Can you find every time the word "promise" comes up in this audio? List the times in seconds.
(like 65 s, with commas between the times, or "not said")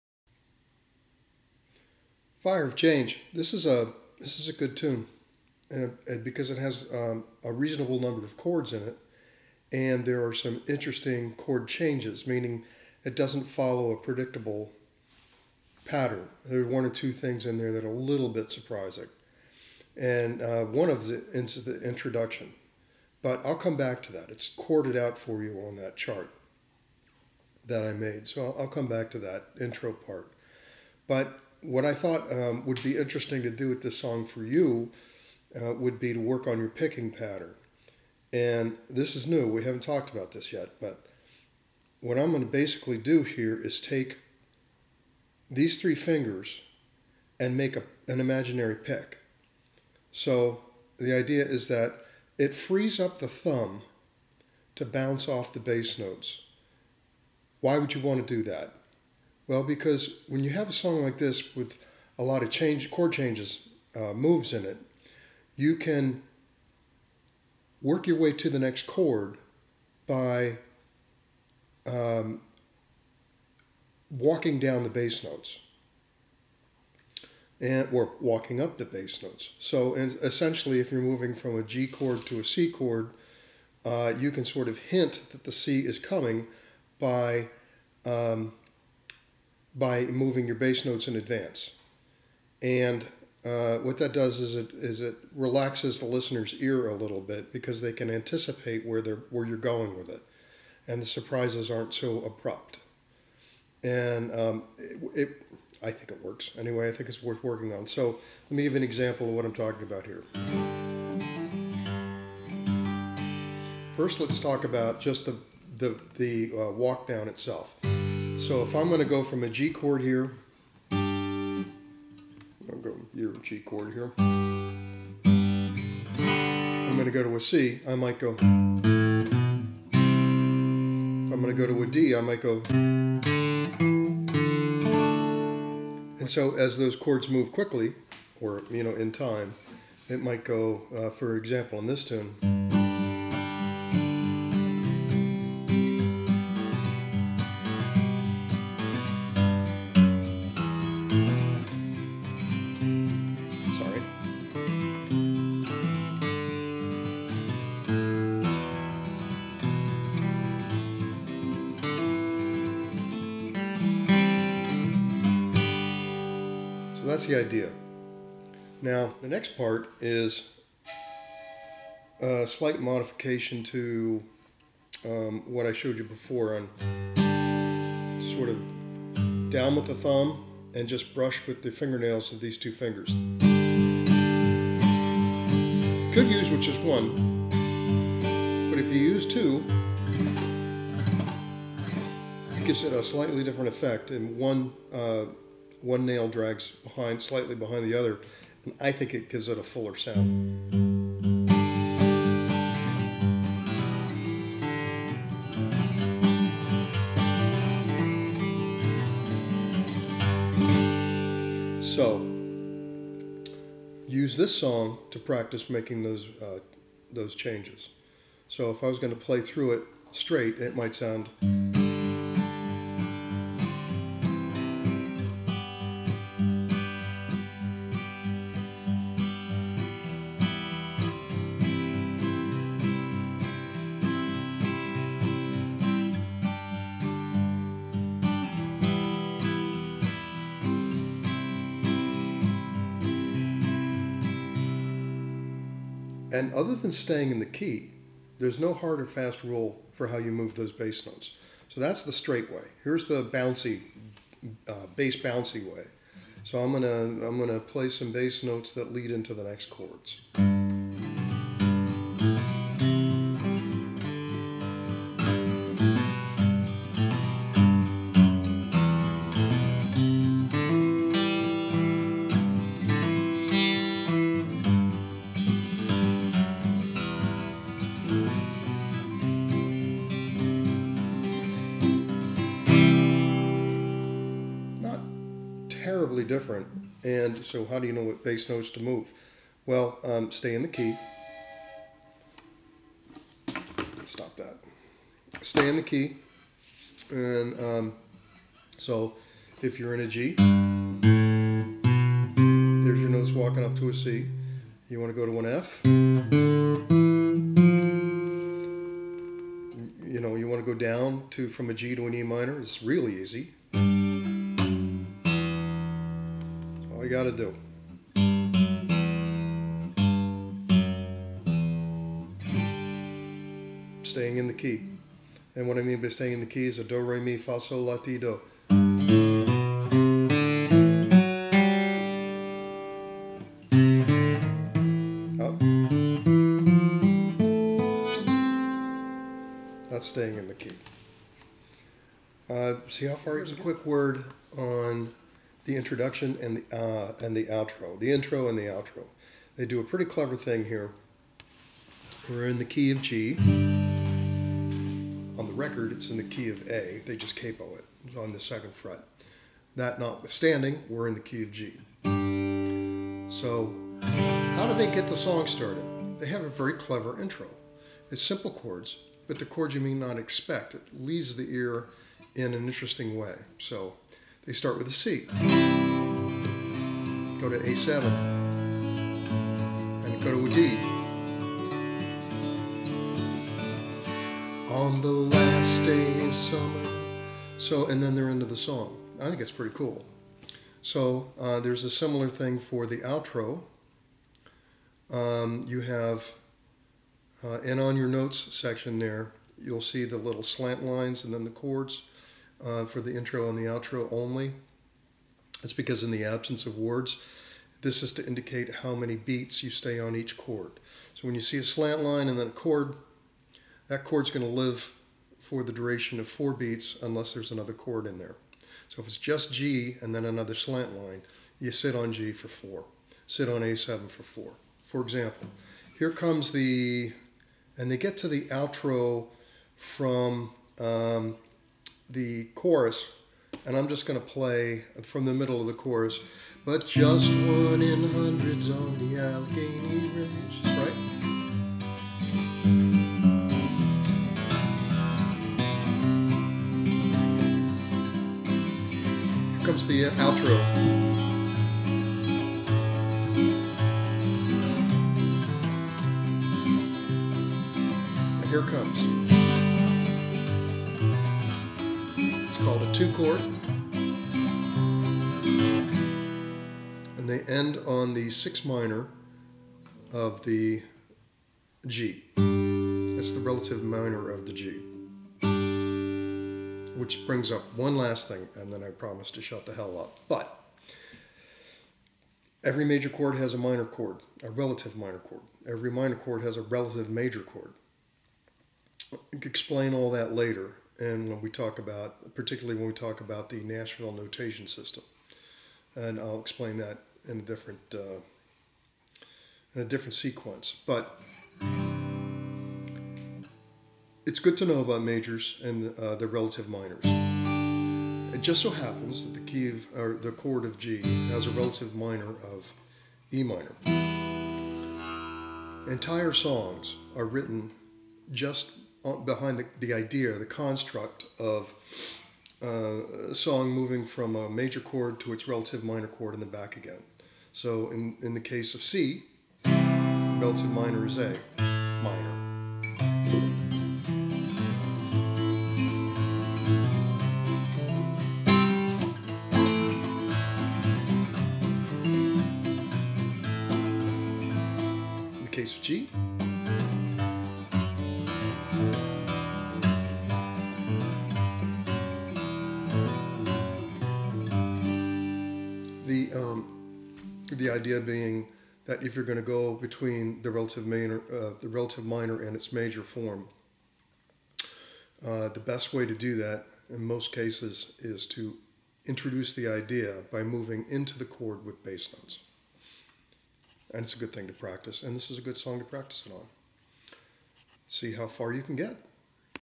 478 s.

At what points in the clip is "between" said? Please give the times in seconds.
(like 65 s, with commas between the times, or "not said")
559 s.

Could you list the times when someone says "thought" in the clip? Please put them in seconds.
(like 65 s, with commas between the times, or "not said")
31 s.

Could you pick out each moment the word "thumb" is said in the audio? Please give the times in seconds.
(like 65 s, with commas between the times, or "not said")
53 s, 179 s.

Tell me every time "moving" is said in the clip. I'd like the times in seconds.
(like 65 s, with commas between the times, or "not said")
81 s, 90 s, 523 s, 570 s.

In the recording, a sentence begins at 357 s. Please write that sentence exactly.
They just capo it it's on the second fret.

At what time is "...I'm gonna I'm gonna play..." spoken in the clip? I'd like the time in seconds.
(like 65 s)
256 s.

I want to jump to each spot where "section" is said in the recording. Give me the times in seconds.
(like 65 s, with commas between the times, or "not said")
398 s.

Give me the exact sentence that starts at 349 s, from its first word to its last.
They do a pretty clever thing here.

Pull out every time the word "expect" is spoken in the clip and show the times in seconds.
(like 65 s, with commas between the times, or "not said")
370 s.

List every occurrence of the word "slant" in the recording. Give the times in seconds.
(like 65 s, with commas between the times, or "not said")
400 s, 411 s, 420 s.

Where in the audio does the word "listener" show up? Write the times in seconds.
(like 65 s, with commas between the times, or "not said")
96 s.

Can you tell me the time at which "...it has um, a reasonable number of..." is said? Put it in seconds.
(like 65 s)
6 s.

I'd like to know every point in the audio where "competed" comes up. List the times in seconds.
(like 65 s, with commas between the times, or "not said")
not said.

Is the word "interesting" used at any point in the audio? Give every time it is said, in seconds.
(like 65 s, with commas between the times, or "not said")
10 s, 32 s, 372 s.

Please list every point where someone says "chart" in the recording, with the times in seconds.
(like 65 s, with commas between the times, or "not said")
25 s.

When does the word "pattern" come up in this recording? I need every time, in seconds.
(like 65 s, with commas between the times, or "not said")
15 s, 37 s.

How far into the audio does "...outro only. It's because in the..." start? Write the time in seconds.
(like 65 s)
403 s.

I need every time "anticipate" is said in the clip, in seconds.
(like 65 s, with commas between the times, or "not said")
98 s.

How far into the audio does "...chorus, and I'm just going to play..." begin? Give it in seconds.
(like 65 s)
432 s.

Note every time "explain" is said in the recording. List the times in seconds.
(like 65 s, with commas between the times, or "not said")
489 s, 496 s.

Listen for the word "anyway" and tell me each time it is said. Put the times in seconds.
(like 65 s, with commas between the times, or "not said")
106 s.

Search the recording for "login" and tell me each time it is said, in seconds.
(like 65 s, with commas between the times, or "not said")
not said.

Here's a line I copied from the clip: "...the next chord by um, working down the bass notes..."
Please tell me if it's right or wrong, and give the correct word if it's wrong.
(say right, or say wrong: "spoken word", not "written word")
wrong: "walking", not "working".